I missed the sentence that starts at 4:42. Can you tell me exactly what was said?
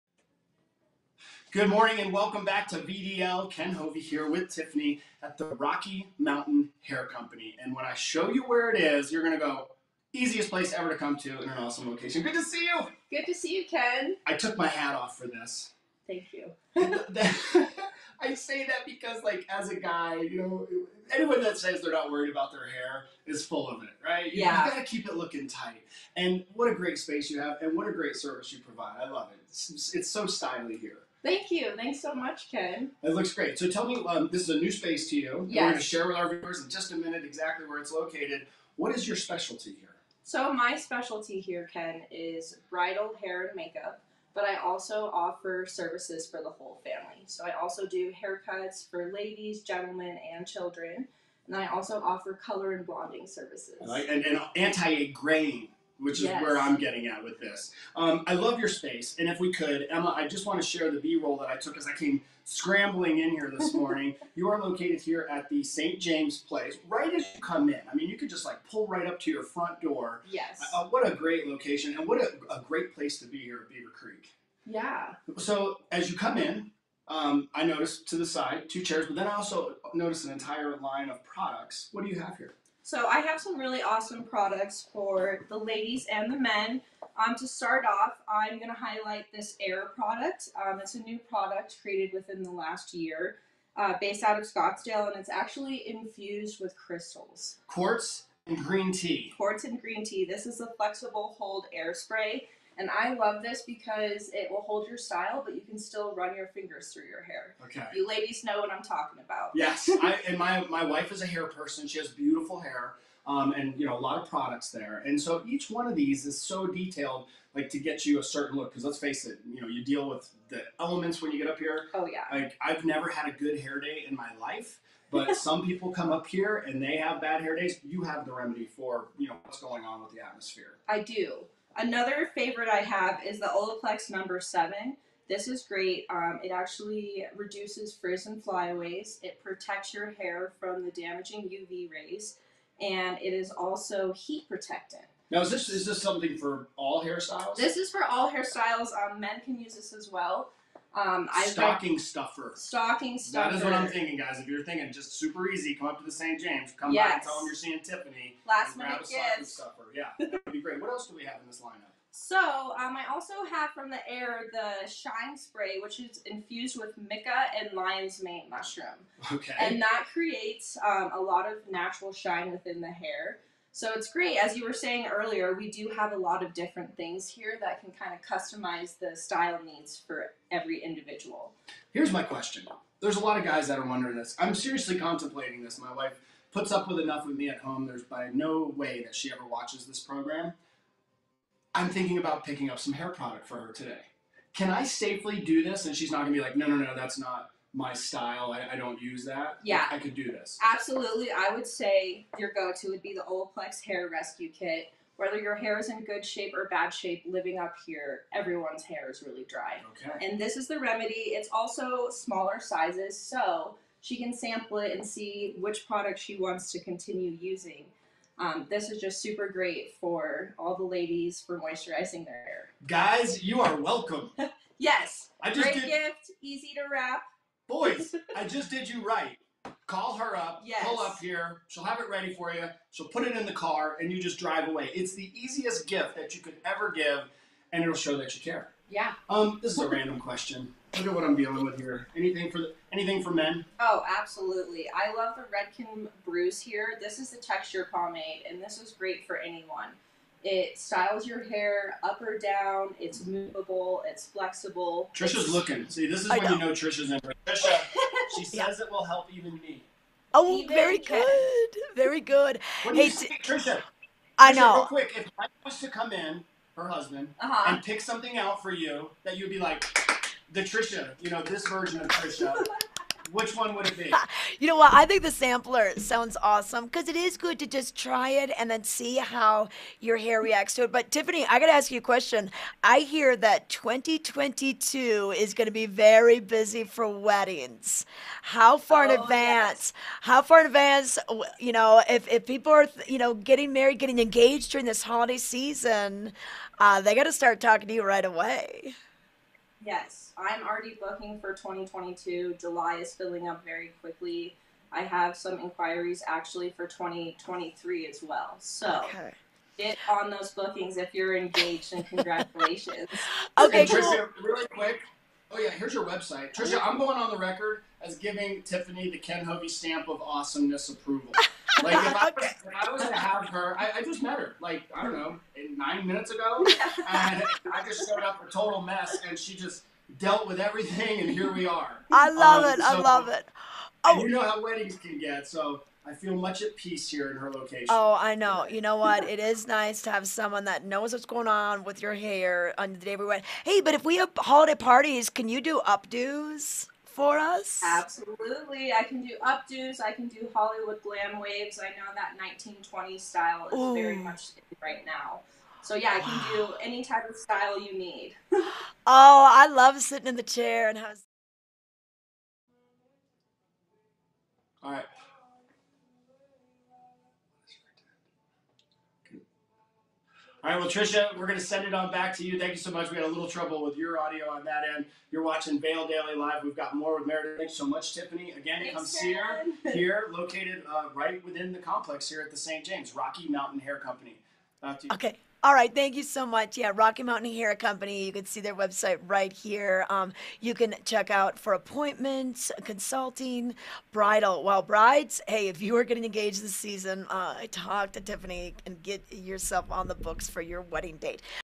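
I hear that 2022 is going to be very busy for weddings.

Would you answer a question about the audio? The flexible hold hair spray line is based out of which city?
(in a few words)
Scottsdale.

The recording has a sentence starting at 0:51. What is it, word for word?
And I also offer color and blonding services.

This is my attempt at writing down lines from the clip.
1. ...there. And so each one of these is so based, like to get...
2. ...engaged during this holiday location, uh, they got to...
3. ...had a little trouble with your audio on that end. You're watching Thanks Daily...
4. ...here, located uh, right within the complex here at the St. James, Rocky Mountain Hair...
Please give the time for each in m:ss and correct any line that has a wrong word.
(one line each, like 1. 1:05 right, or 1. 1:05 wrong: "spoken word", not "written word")
1. 1:54 wrong: "detailed", not "based"
2. 4:54 wrong: "season", not "location"
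3. 6:13 wrong: "Vail", not "Thanks"
4. 6:19 right.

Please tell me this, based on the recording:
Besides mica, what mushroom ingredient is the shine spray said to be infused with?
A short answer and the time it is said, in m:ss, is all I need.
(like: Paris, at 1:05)
lion's mane, at 2:47.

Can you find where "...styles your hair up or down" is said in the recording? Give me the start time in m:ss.
4:10.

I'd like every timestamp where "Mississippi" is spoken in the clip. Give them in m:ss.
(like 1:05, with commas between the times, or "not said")
not said.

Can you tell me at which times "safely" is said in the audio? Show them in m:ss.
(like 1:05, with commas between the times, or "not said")
3:14.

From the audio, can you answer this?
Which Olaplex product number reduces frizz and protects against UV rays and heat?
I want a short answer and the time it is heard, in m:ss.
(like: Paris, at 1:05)
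7, at 2:14.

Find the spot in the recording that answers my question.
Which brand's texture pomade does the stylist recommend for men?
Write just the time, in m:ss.
4:05.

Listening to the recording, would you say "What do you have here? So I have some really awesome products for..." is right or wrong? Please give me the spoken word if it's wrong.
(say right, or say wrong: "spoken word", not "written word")
right.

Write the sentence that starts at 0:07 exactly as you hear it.
And when I show you where it is, you're going to go, easiest place ever to come to in an awesome location.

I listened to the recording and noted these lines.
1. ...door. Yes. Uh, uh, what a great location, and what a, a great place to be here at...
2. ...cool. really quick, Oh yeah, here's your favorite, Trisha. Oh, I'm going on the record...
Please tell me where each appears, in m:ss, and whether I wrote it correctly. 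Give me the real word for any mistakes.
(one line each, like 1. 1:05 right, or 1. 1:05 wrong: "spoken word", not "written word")
1. 1:09 right
2. 5:13 wrong: "website", not "favorite".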